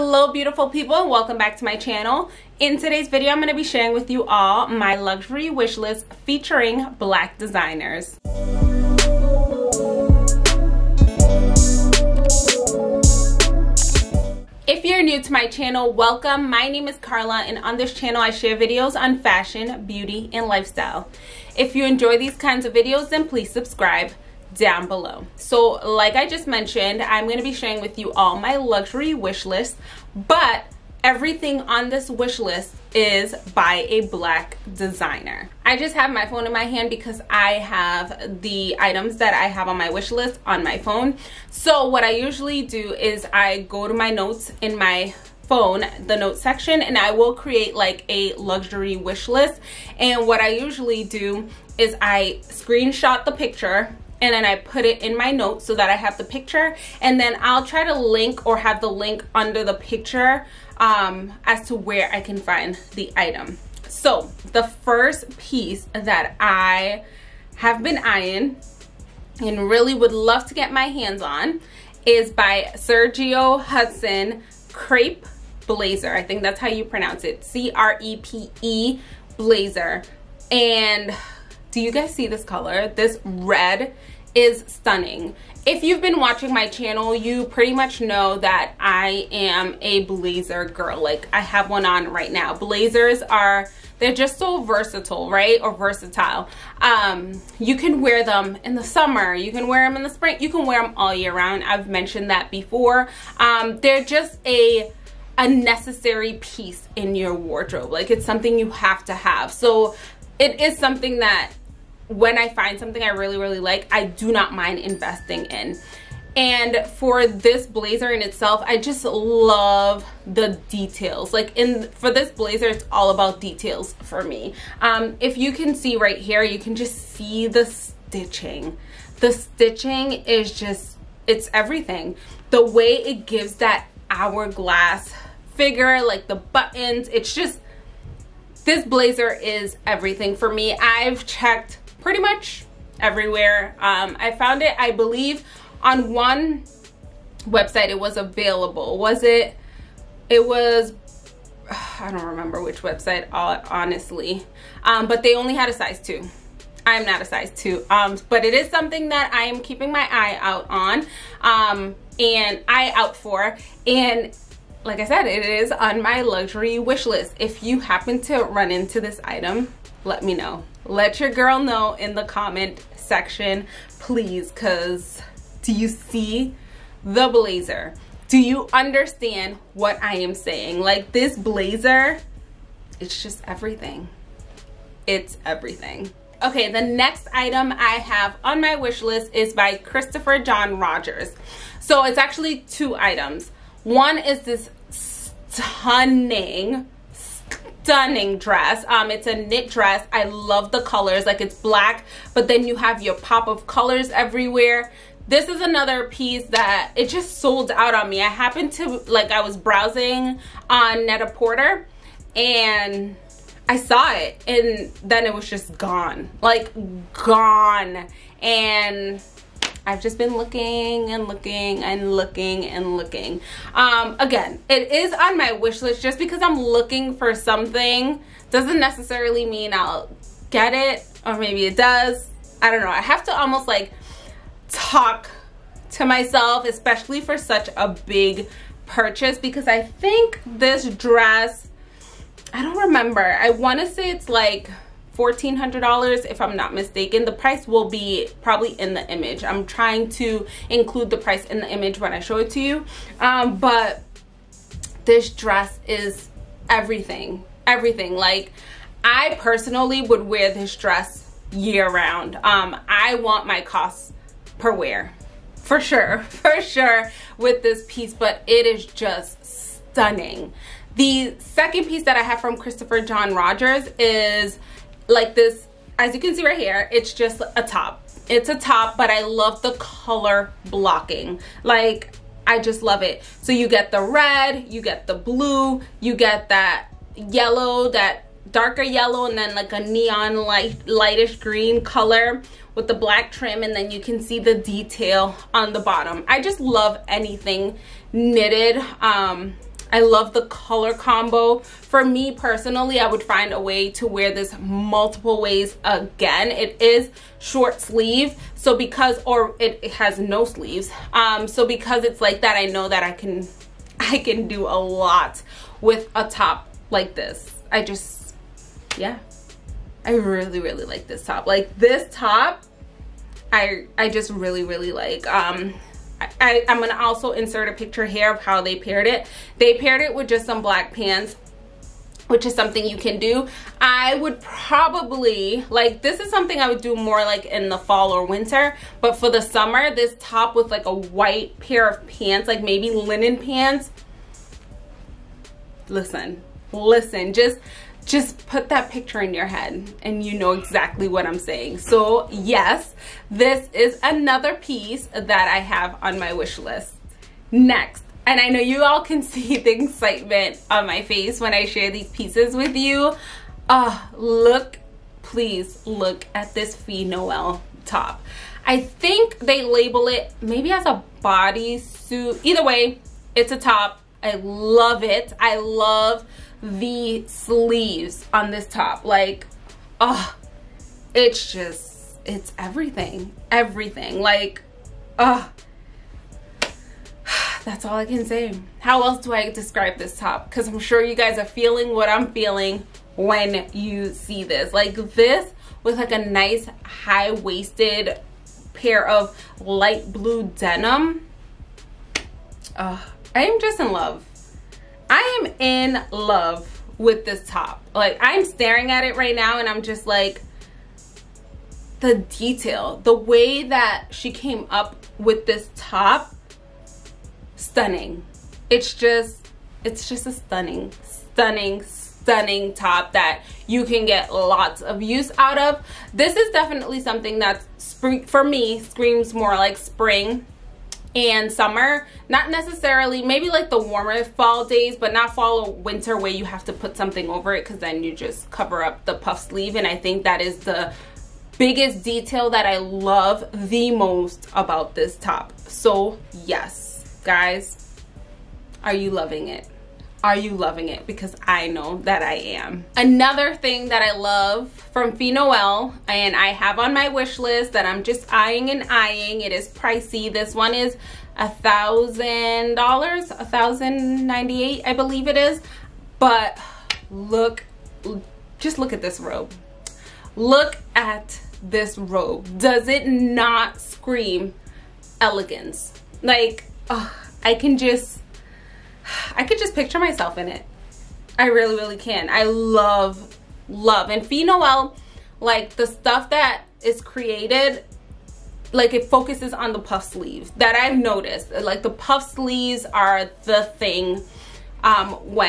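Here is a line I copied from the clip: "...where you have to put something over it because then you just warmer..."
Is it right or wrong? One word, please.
wrong.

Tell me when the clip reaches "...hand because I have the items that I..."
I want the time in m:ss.
0:36.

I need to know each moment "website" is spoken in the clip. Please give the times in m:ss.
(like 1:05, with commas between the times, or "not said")
2:27, 2:32.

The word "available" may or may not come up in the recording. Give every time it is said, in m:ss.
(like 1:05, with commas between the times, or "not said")
2:28.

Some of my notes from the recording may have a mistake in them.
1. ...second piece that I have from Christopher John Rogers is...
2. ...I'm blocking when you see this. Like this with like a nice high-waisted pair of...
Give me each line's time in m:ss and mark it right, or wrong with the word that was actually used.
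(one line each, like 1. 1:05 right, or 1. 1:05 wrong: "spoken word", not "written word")
1. 4:31 right
2. 6:32 wrong: "feeling", not "blocking".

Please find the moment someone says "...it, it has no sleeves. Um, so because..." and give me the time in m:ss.
5:09.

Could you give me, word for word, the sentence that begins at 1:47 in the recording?
Like it's something you have to have.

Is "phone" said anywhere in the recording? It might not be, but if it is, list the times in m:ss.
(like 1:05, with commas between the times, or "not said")
0:36, 0:40, 0:45.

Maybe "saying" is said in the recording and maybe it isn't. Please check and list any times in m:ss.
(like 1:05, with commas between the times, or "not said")
3:00, 5:51.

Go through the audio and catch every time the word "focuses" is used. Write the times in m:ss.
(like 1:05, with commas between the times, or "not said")
8:09.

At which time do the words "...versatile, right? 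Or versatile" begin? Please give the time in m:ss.
1:34.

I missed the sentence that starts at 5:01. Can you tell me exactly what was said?
For me personally, I would find a way to wear this multiple ways again.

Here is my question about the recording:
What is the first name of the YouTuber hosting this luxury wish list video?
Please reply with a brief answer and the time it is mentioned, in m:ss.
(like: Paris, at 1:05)
Carla, at 0:16.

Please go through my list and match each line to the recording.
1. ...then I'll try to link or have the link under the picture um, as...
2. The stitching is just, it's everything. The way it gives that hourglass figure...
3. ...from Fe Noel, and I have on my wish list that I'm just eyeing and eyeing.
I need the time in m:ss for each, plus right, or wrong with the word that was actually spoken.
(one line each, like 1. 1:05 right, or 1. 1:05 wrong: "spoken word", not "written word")
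1. 0:57 right
2. 2:09 right
3. 7:34 right.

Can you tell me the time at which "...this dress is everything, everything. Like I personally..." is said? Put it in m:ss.
4:15.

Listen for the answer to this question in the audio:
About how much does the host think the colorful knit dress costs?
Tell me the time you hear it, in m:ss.
4:05.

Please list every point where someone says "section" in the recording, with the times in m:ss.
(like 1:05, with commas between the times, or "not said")
0:46, 2:52.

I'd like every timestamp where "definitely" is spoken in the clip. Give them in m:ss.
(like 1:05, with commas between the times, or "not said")
7:06.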